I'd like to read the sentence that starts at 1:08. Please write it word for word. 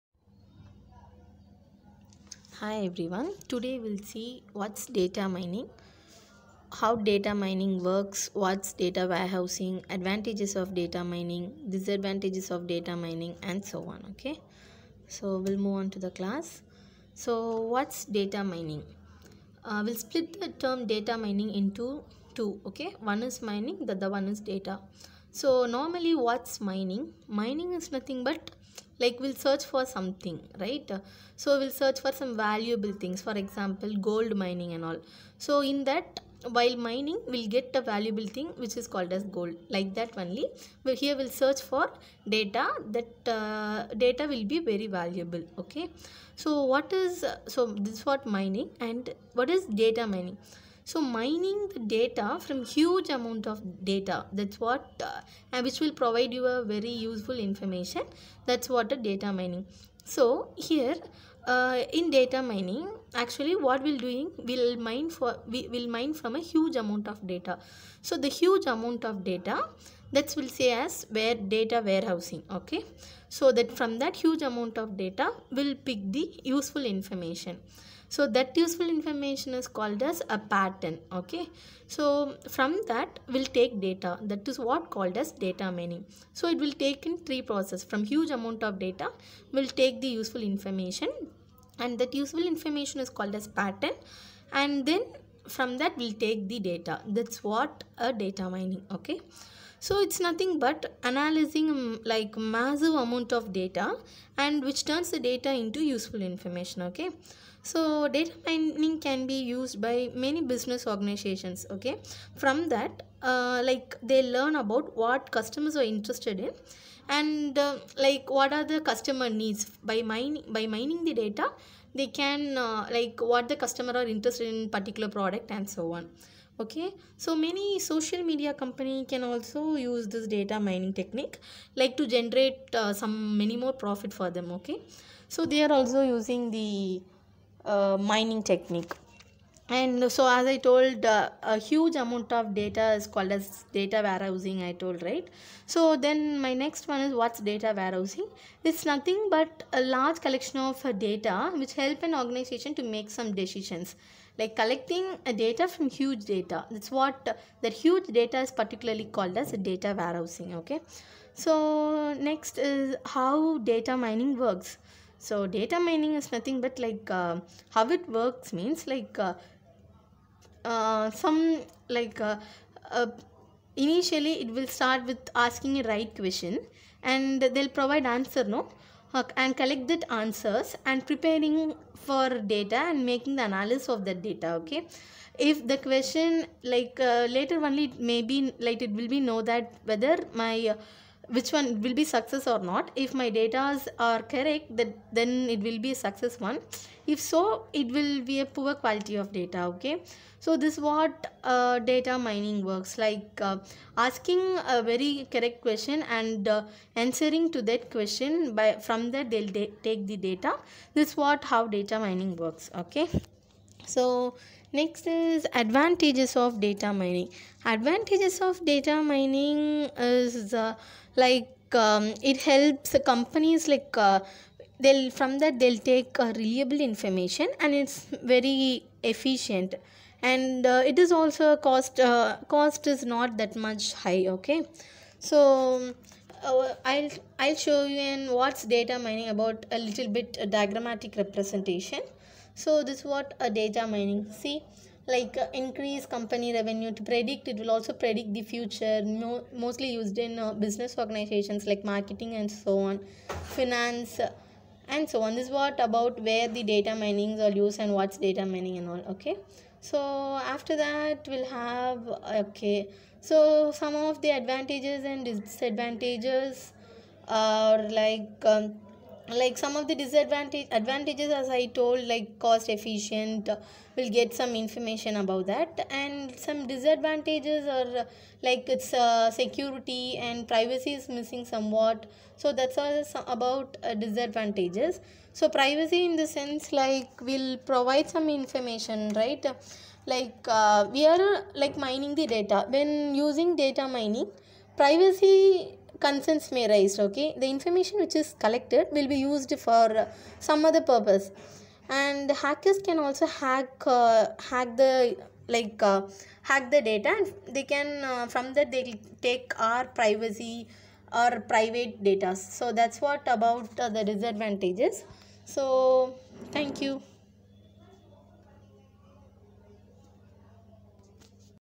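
So the huge amount of data, that will say as where data warehousing, okay.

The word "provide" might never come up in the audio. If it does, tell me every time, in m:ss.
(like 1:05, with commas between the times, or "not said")
0:55, 2:57, 4:47.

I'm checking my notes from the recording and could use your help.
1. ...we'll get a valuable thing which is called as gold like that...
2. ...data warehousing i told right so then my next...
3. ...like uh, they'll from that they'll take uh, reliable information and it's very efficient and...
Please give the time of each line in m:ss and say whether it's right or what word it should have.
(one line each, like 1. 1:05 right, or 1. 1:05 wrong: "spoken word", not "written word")
1. 0:37 right
2. 2:23 right
3. 3:43 right.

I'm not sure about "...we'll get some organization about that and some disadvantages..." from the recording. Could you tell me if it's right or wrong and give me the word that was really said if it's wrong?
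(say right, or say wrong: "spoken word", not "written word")
wrong: "information", not "organization".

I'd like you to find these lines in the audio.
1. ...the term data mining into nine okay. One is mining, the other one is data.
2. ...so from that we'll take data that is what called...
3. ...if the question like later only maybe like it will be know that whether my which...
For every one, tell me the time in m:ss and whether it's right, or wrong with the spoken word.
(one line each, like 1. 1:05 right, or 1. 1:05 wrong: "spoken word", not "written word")
1. 0:20 wrong: "two", not "nine"
2. 1:21 right
3. 3:05 right.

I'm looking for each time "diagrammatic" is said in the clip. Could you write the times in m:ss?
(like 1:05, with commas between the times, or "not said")
4:00.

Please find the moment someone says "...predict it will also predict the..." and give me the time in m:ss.
4:07.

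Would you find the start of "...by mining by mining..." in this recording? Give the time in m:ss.
1:59.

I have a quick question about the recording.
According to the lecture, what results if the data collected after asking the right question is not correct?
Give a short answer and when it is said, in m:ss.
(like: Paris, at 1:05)
poor quality of data, at 3:18.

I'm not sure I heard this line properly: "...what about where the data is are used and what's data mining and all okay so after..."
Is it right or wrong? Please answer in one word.
right.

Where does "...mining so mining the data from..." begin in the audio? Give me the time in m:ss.
0:50.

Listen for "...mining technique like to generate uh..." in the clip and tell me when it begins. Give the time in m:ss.
2:10.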